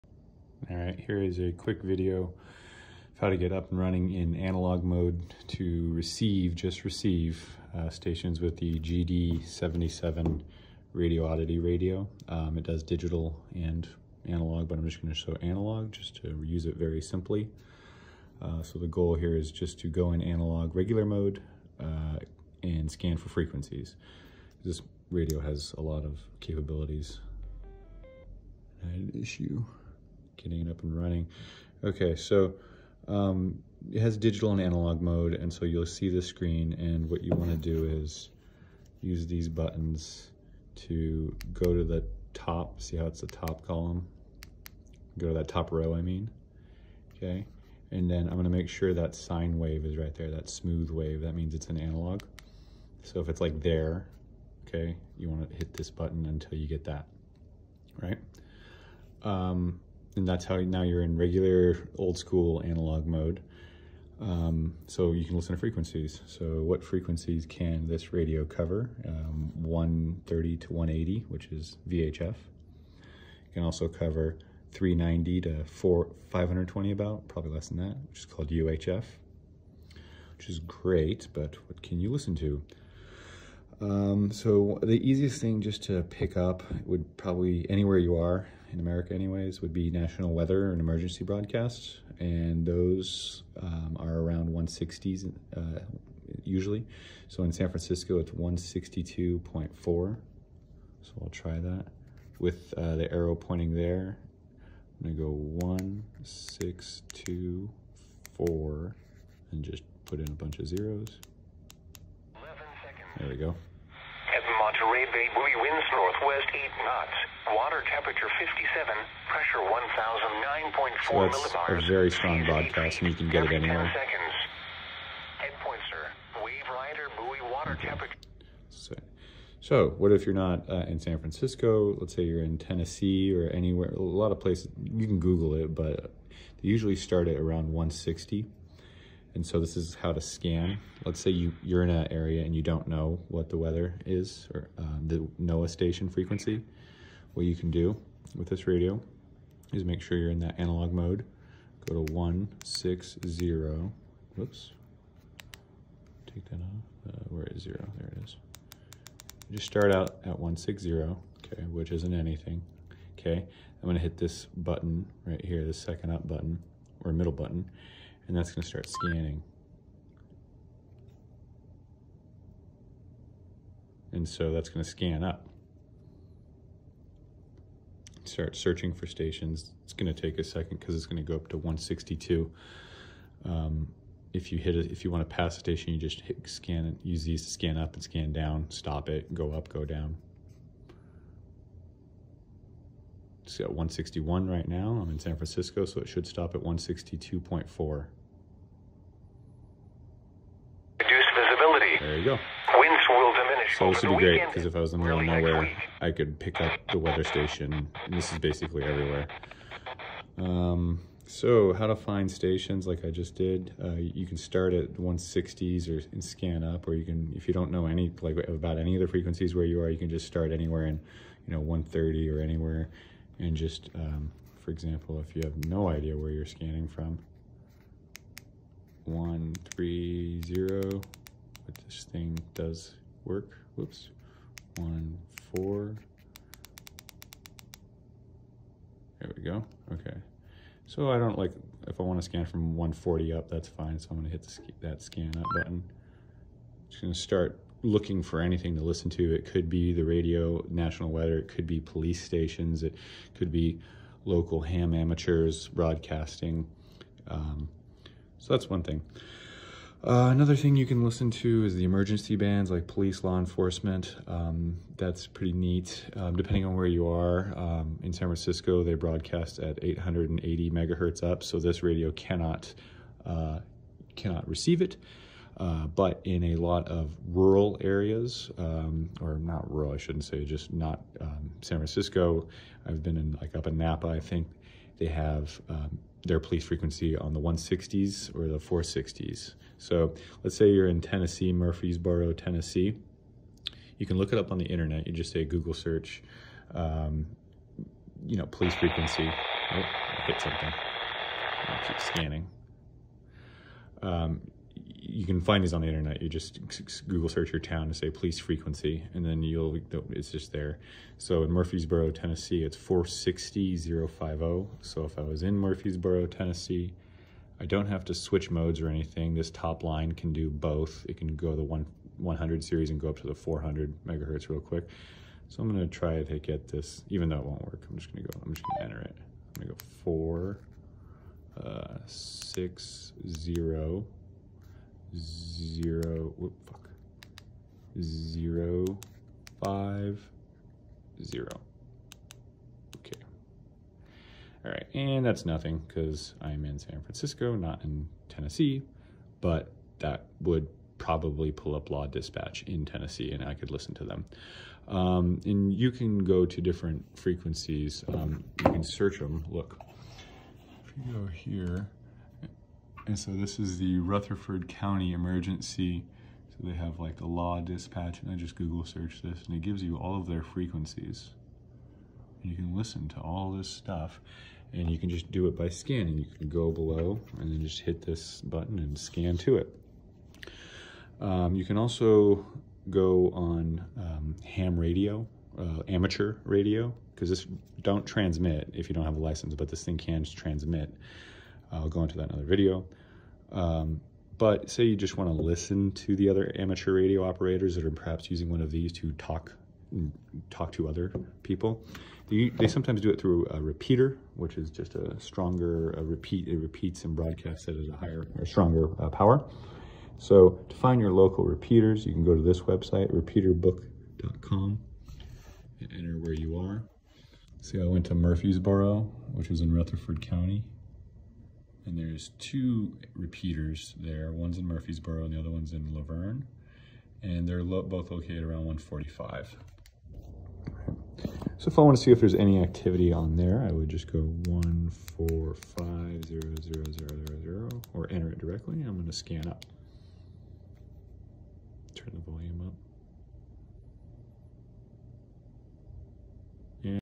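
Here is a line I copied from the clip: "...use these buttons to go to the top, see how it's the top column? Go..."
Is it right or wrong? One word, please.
right.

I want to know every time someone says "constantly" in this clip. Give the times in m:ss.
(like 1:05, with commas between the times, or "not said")
not said.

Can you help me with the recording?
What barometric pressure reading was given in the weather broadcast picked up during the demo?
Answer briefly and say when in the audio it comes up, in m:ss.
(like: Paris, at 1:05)
1009.4, at 1:59.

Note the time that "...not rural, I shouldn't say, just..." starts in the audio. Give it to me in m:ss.
4:39.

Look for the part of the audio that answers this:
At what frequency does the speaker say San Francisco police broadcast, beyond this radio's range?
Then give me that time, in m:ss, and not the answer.
4:29.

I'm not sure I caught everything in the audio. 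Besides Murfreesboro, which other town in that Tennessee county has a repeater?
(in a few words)
La Vergne.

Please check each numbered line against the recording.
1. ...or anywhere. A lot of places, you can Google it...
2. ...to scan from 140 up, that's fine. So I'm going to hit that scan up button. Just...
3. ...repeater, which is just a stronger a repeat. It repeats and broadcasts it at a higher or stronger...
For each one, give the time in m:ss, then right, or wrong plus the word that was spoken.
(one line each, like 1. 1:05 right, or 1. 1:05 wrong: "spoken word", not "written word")
1. 2:13 right
2. 4:02 right
3. 6:43 right.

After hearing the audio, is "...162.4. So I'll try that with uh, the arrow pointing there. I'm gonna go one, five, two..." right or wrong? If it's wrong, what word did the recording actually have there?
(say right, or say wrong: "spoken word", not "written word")
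wrong: "six", not "five".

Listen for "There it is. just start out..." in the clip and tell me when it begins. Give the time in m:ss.
2:37.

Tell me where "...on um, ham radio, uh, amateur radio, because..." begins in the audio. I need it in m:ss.
6:23.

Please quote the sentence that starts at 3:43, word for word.
And just, um, for example, if you have no idea where you're scanning from, 130, this thing does work.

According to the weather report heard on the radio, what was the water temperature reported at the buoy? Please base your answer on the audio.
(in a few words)
57.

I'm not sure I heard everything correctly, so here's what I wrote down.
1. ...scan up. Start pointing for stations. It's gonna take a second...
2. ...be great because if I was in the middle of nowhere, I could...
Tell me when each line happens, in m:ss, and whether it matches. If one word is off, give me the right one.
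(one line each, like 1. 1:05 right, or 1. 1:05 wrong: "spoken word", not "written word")
1. 2:54 wrong: "searching", not "pointing"
2. 3:24 right.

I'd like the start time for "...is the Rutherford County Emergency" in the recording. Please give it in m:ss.
6:03.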